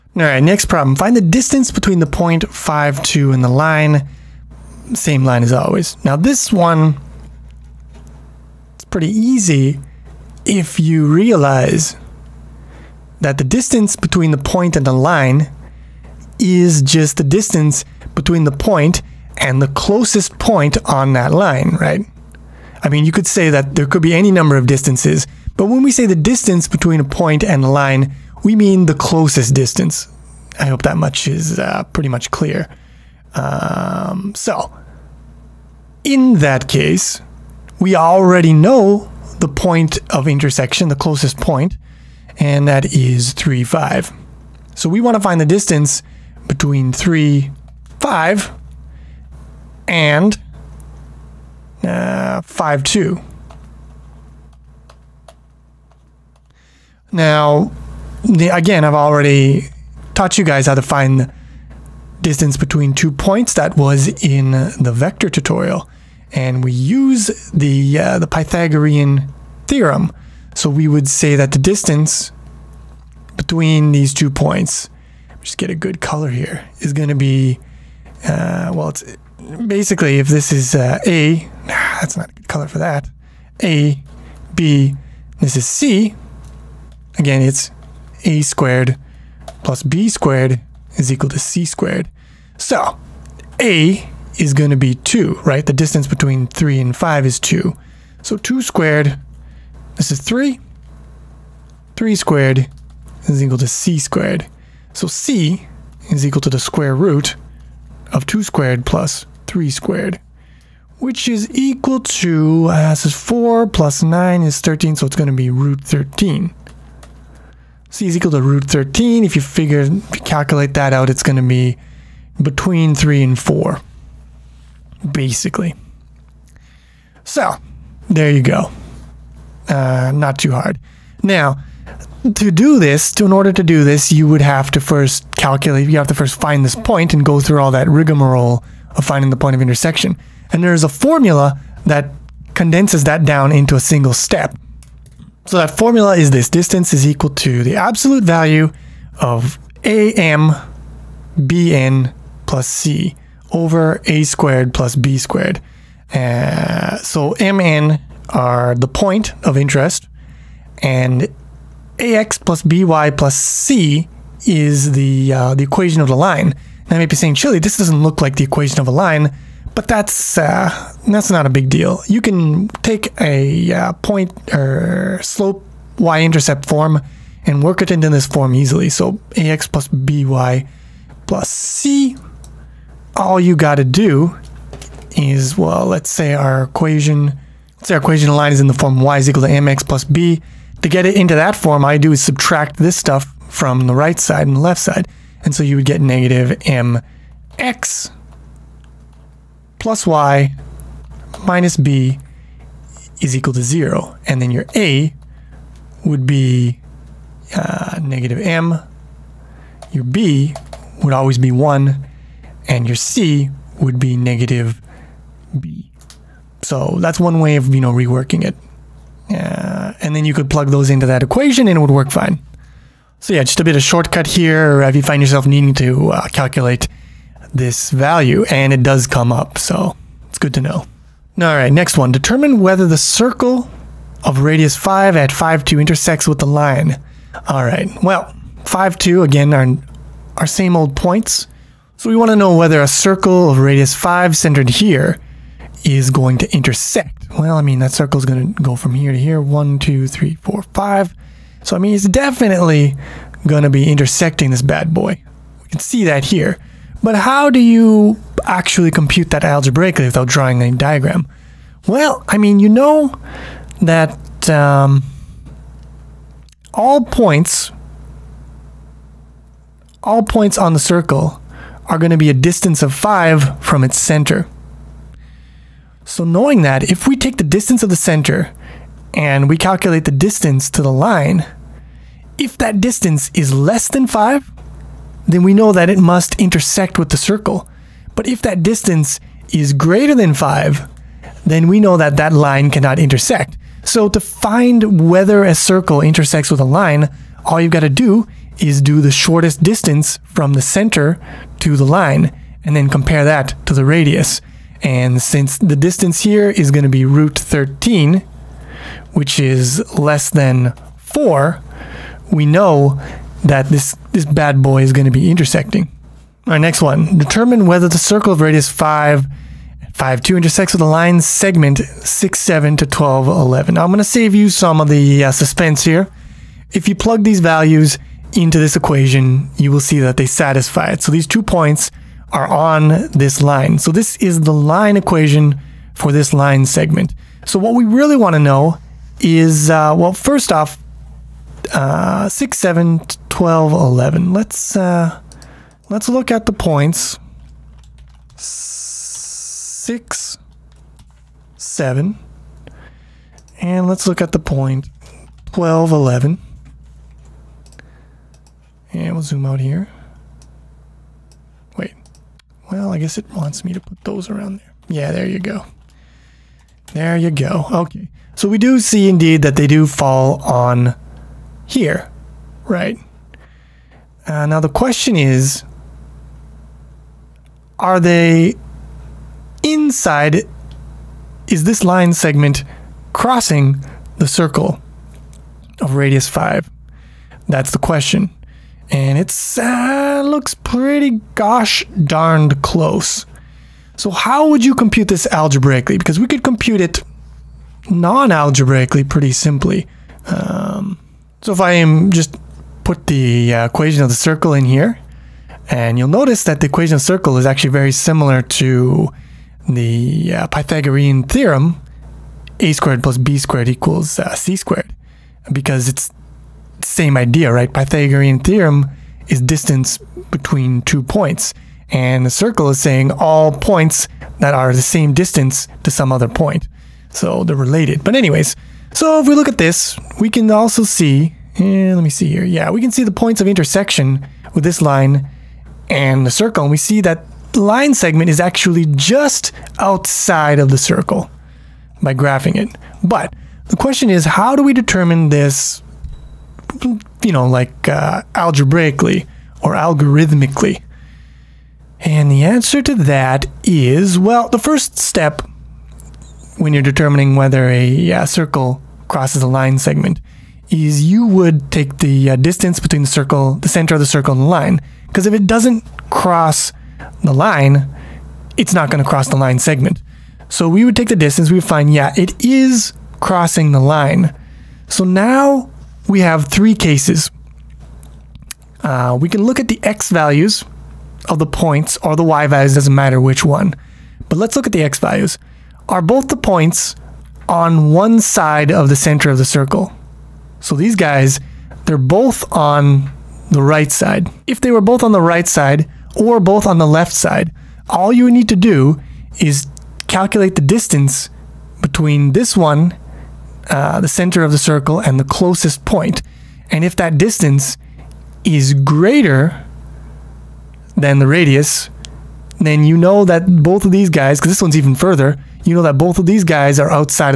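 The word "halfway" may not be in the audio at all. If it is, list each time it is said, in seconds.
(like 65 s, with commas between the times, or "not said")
not said.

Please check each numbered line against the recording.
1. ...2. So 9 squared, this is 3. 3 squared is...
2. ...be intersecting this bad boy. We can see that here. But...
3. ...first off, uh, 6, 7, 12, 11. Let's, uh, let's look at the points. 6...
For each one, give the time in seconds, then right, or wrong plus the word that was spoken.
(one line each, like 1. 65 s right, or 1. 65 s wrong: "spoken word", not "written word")
1. 97 s wrong: "2", not "9"
2. 253 s right
3. 340 s right.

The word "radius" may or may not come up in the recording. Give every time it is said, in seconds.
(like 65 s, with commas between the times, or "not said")
234 s, 243 s, 303 s, 318 s, 385 s, 511 s.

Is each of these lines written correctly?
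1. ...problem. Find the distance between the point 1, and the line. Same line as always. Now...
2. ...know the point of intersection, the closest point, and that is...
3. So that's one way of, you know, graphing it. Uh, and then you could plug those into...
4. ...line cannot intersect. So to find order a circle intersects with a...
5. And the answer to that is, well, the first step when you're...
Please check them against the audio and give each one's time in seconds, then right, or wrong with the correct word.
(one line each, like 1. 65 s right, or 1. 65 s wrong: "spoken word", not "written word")
1. 0 s wrong: "2", not "1"
2. 38 s right
3. 216 s wrong: "reworking", not "graphing"
4. 292 s wrong: "whether", not "order"
5. 451 s right.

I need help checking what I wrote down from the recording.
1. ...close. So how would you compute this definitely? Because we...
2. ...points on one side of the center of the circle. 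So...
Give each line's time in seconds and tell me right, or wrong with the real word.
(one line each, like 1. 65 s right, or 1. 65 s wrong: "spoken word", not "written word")
1. 392 s wrong: "algebraically", not "definitely"
2. 486 s right.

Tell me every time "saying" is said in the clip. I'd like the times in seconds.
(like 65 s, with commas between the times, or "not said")
167 s, 422 s.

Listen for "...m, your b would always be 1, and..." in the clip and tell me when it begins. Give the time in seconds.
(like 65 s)
208 s.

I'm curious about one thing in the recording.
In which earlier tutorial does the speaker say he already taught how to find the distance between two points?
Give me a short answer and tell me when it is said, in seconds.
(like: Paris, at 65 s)
the vector tutorial, at 64 s.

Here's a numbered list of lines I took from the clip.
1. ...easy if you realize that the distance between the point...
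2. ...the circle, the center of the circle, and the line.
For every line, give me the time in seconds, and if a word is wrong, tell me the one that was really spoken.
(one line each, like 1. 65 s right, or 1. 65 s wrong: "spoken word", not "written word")
1. 9 s right
2. 463 s right.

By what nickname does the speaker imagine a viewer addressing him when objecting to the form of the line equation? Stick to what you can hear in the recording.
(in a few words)
Chili.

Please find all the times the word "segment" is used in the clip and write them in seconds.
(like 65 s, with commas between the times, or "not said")
321 s, 336 s, 382 s, 437 s, 459 s, 469 s.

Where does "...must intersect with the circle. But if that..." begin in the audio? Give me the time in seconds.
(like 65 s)
285 s.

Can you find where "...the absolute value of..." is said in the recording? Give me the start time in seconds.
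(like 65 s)
147 s.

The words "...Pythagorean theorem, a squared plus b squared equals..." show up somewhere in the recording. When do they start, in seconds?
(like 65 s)
410 s.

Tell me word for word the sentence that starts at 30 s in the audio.
I hope that much is uh, pretty much clear.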